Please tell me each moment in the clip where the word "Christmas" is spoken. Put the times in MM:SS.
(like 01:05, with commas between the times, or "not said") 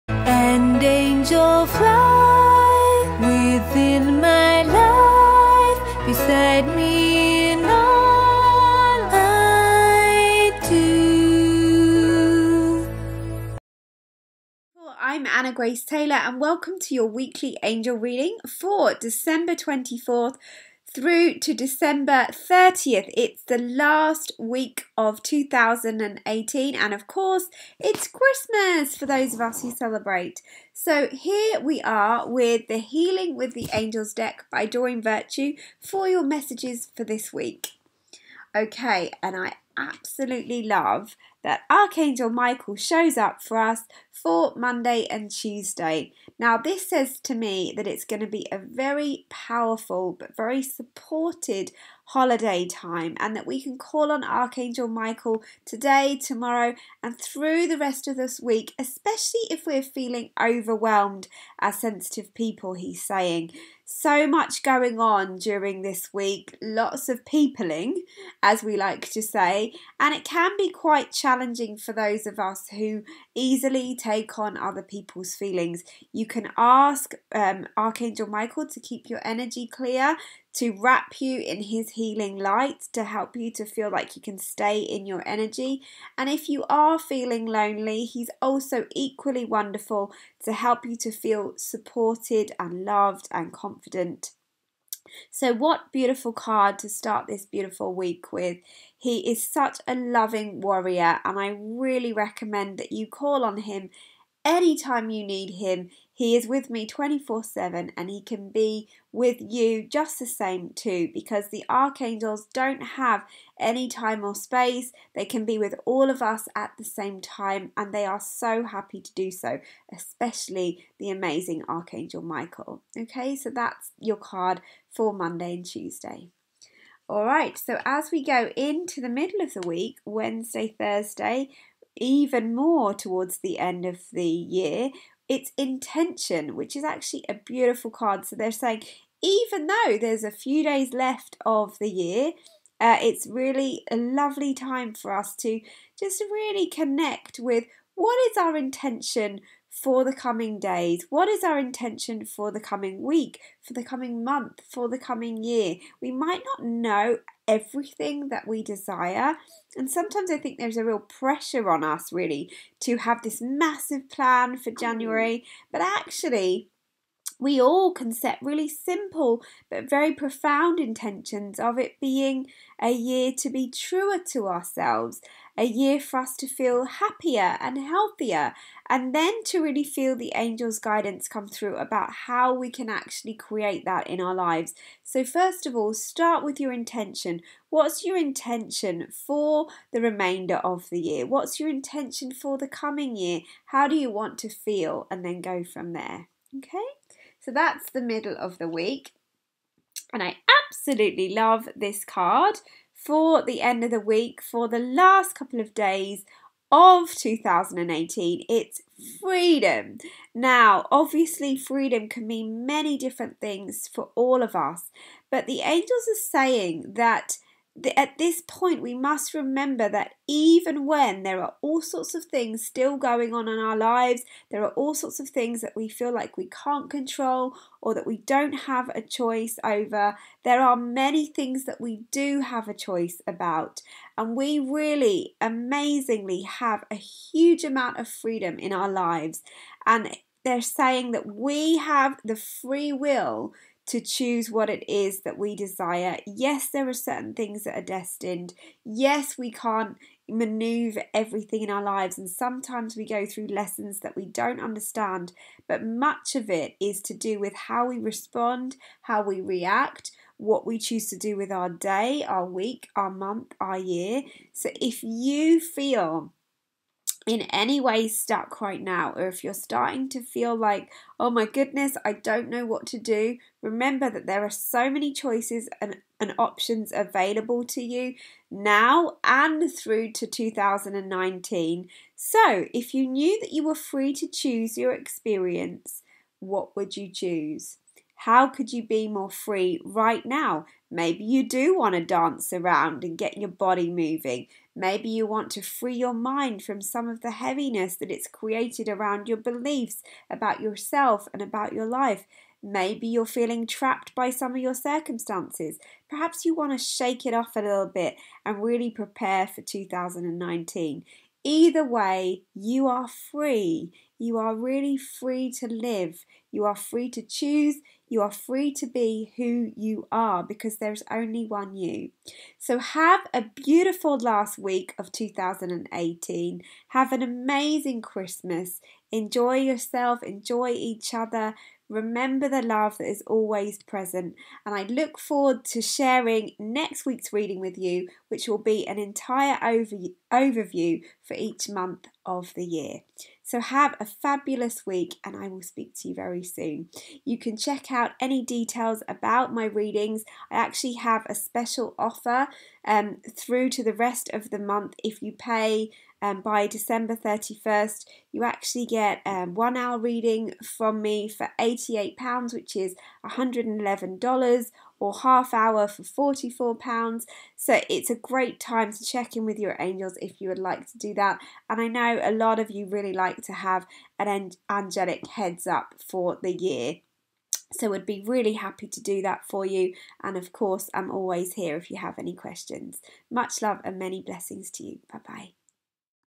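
00:28, 05:28.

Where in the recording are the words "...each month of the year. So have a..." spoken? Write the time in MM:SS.
05:41.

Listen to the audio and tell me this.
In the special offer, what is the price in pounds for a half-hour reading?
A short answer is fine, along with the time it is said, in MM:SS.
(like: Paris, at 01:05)
£44, at 06:06.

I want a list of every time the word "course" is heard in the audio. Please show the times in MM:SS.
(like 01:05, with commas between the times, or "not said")
00:27, 06:20.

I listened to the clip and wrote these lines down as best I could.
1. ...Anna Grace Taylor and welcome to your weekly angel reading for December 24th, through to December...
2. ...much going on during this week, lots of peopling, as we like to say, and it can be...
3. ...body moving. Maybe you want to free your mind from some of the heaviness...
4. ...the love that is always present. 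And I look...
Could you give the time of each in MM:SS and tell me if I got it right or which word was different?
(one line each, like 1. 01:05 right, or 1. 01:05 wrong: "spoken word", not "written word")
1. 00:15 right
2. 01:04 right
3. 04:53 right
4. 05:32 right.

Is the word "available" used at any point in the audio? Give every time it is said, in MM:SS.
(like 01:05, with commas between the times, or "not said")
04:36.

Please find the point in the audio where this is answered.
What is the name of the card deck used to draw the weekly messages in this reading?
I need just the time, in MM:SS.
00:32.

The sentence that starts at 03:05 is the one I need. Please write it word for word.
So, first of all, start with your intention.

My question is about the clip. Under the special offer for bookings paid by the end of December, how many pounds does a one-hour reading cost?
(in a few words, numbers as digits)
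£88.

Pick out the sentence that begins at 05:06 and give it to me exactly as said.
Perhaps you want to shake it off a little bit and really prepare for 2019.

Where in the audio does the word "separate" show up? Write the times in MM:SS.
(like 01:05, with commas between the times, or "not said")
not said.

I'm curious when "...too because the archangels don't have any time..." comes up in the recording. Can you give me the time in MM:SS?
01:50.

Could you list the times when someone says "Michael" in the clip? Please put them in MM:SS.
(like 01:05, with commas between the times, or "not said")
00:42, 00:54, 01:18, 02:02.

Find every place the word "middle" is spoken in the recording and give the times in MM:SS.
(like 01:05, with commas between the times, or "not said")
02:09, 03:18.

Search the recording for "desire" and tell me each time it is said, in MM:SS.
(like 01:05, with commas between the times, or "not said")
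02:38, 04:05.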